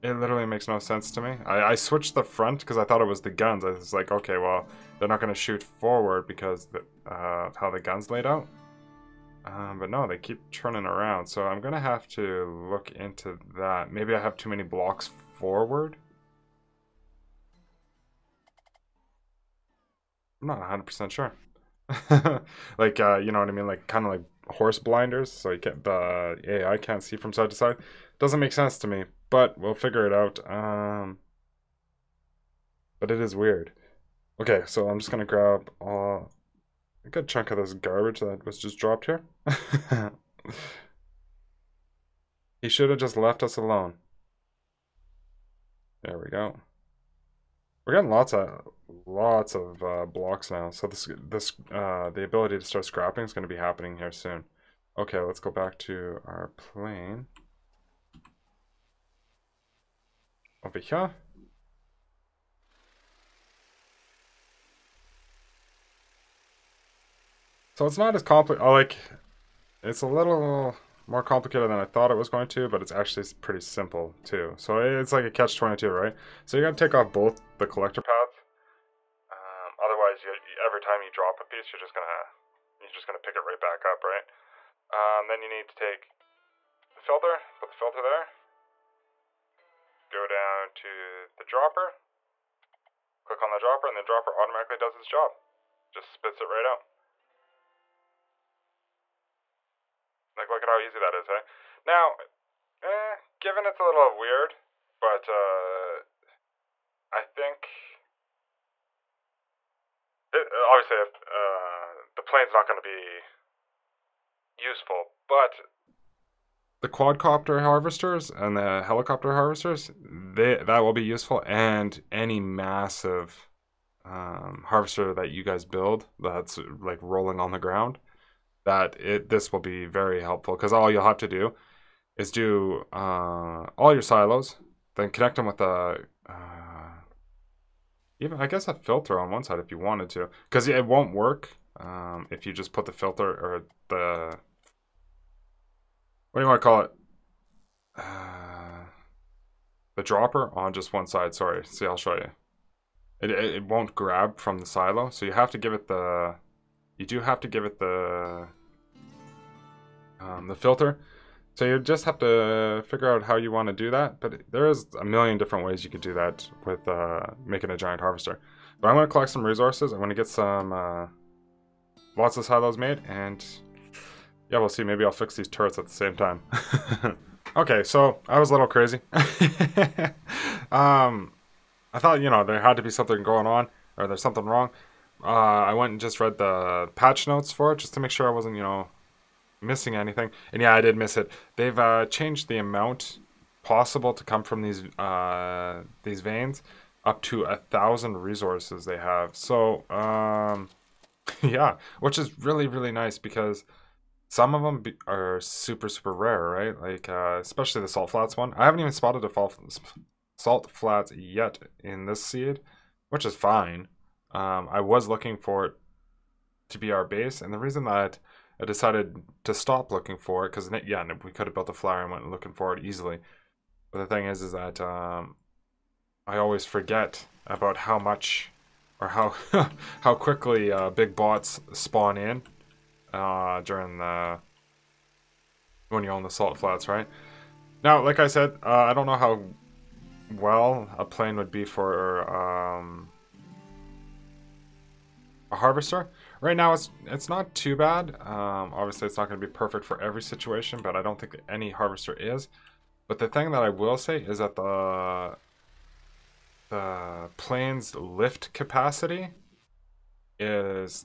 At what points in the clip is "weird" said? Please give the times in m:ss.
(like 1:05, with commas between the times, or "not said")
0:33, 1:44.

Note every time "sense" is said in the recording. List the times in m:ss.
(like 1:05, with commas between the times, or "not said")
0:00, 0:28.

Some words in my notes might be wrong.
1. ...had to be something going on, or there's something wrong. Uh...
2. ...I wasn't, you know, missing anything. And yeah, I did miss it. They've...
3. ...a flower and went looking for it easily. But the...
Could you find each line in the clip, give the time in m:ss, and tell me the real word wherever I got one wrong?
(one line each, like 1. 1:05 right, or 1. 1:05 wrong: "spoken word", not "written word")
1. 3:02 right
2. 3:08 right
3. 3:41 right.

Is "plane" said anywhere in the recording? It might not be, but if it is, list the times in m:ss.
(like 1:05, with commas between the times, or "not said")
0:56, 1:52, 4:01, 4:17.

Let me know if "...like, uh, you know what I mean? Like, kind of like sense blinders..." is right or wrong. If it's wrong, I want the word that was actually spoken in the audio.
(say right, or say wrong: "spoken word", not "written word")
wrong: "horse", not "sense".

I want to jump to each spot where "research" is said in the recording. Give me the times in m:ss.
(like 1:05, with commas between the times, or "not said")
not said.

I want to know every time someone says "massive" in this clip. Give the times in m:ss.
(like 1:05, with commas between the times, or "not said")
2:02.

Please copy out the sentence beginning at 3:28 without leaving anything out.
I haven't even spotted a fall salt flats yet in this seed, which is fine.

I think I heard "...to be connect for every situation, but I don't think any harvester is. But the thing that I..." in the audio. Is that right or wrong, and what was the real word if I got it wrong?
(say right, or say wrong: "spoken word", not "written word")
wrong: "perfect", not "connect".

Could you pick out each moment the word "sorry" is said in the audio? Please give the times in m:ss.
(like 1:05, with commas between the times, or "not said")
2:31.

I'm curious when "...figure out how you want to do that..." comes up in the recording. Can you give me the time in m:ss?
2:42.